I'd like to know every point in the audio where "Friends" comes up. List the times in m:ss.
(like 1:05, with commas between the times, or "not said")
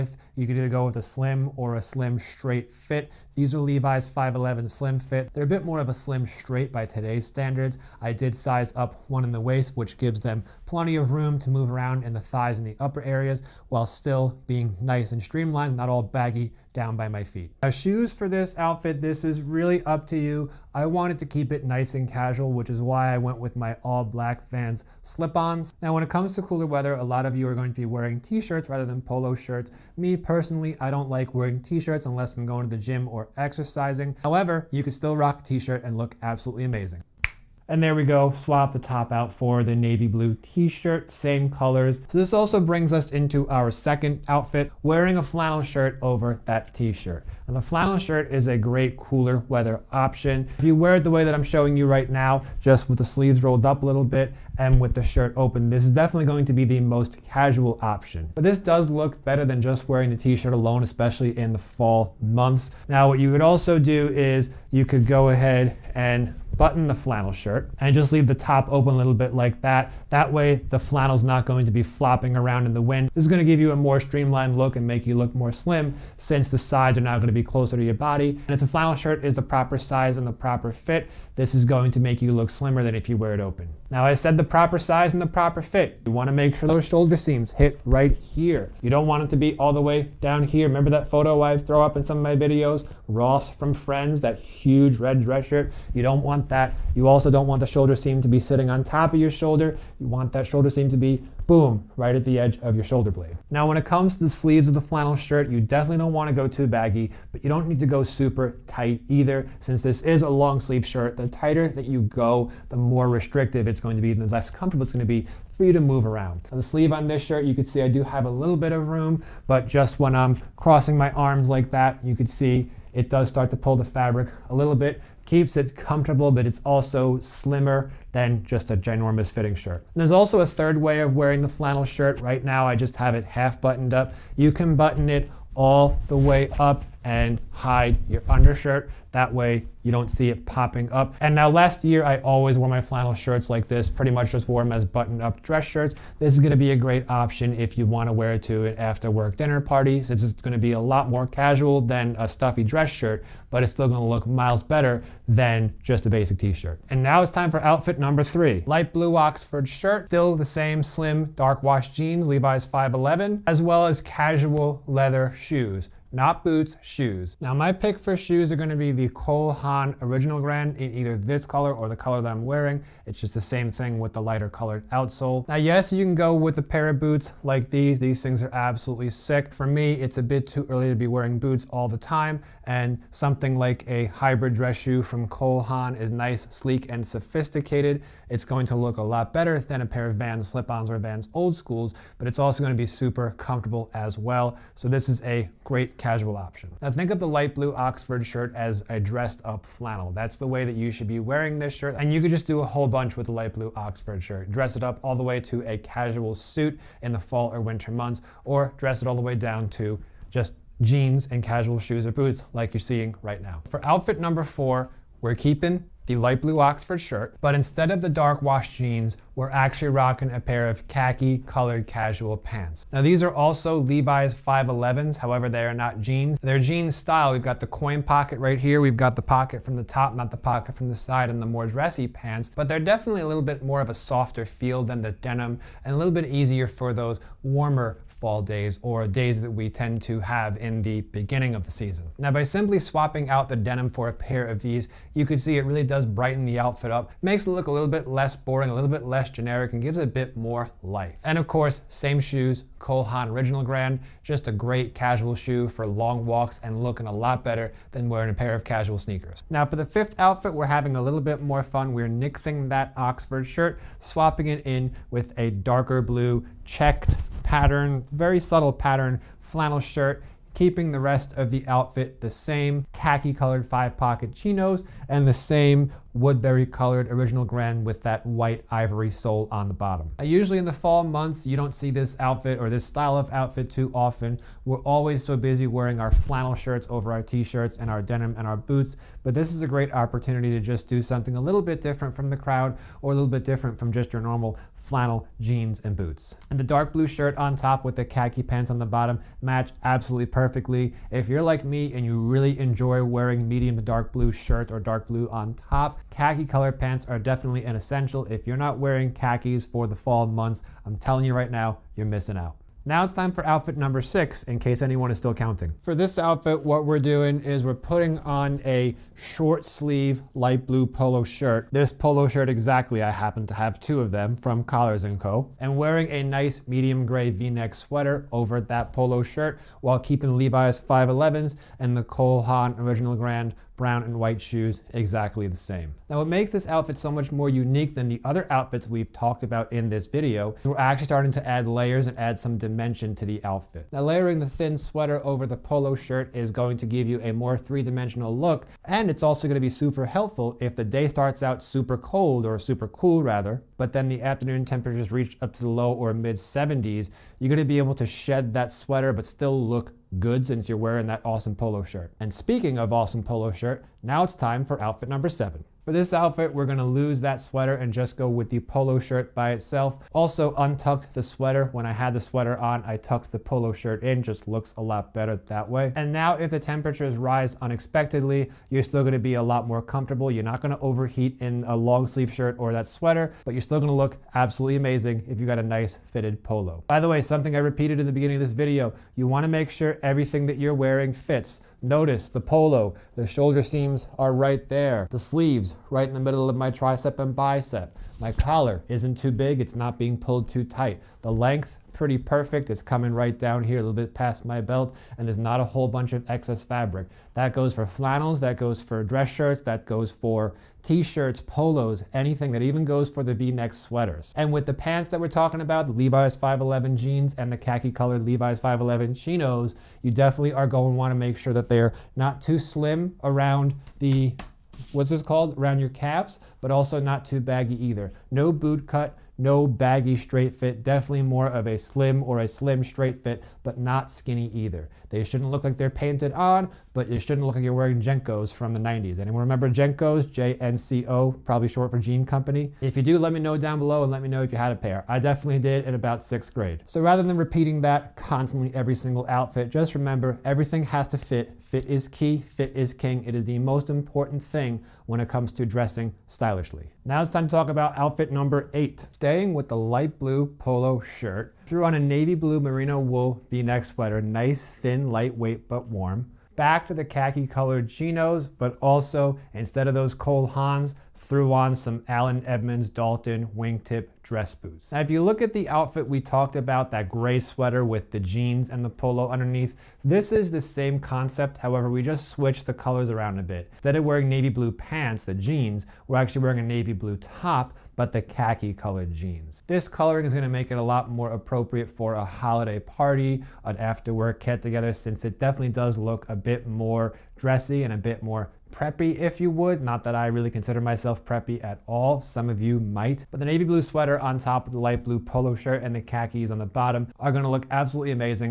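1:33.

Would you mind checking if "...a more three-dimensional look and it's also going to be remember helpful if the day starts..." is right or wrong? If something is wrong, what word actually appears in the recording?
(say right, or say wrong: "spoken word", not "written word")
wrong: "super", not "remember".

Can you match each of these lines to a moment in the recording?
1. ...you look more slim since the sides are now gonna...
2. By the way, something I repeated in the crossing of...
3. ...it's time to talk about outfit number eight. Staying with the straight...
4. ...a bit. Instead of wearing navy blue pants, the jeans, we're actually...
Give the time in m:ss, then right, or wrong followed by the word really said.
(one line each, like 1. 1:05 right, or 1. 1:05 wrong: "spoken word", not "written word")
1. 1:15 right
2. 6:26 wrong: "beginning", not "crossing"
3. 7:37 wrong: "light", not "straight"
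4. 8:03 right.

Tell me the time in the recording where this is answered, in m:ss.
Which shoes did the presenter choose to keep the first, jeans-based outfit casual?
0:23.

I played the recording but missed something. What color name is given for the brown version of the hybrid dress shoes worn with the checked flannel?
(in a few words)
Woodbury.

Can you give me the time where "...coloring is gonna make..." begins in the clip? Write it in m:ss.
8:09.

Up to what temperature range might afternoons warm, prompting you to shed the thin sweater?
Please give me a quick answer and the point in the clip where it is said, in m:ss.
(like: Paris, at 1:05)
Low or mid 70s, at 5:55.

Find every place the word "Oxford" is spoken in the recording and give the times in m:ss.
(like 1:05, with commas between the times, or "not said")
2:39, 3:17, 3:23, 3:36, 4:22.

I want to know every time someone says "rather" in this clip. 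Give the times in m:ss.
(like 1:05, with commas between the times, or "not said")
0:28, 5:53, 7:27.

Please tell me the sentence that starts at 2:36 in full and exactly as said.
And now it's time for outfit number three.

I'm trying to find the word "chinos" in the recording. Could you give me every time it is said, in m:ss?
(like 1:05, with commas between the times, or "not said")
4:34, 6:59, 7:47.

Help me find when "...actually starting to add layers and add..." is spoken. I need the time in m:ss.
5:40.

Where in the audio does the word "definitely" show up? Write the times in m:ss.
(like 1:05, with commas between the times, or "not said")
0:55, 1:45, 3:52, 5:07, 7:00, 7:10, 7:25, 8:15.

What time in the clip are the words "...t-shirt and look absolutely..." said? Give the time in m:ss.
0:35.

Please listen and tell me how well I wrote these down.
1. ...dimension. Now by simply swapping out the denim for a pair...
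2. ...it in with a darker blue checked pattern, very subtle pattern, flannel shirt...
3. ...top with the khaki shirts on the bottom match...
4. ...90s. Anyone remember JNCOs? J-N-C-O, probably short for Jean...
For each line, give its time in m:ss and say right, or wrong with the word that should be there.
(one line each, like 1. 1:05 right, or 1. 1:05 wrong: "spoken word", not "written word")
1. 4:01 wrong: "season", not "dimension"
2. 4:24 right
3. 4:57 wrong: "pants", not "shirts"
4. 7:18 right.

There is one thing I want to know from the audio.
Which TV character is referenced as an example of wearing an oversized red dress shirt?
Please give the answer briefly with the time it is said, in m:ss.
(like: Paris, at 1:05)
Ross, at 1:33.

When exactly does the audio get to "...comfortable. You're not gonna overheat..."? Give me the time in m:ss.
6:19.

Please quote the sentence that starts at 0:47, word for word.
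And the flannel shirt is a great cooler weather option.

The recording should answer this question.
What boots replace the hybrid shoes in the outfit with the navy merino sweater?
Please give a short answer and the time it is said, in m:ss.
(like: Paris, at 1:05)
Allen Edmonds Dalton, at 7:52.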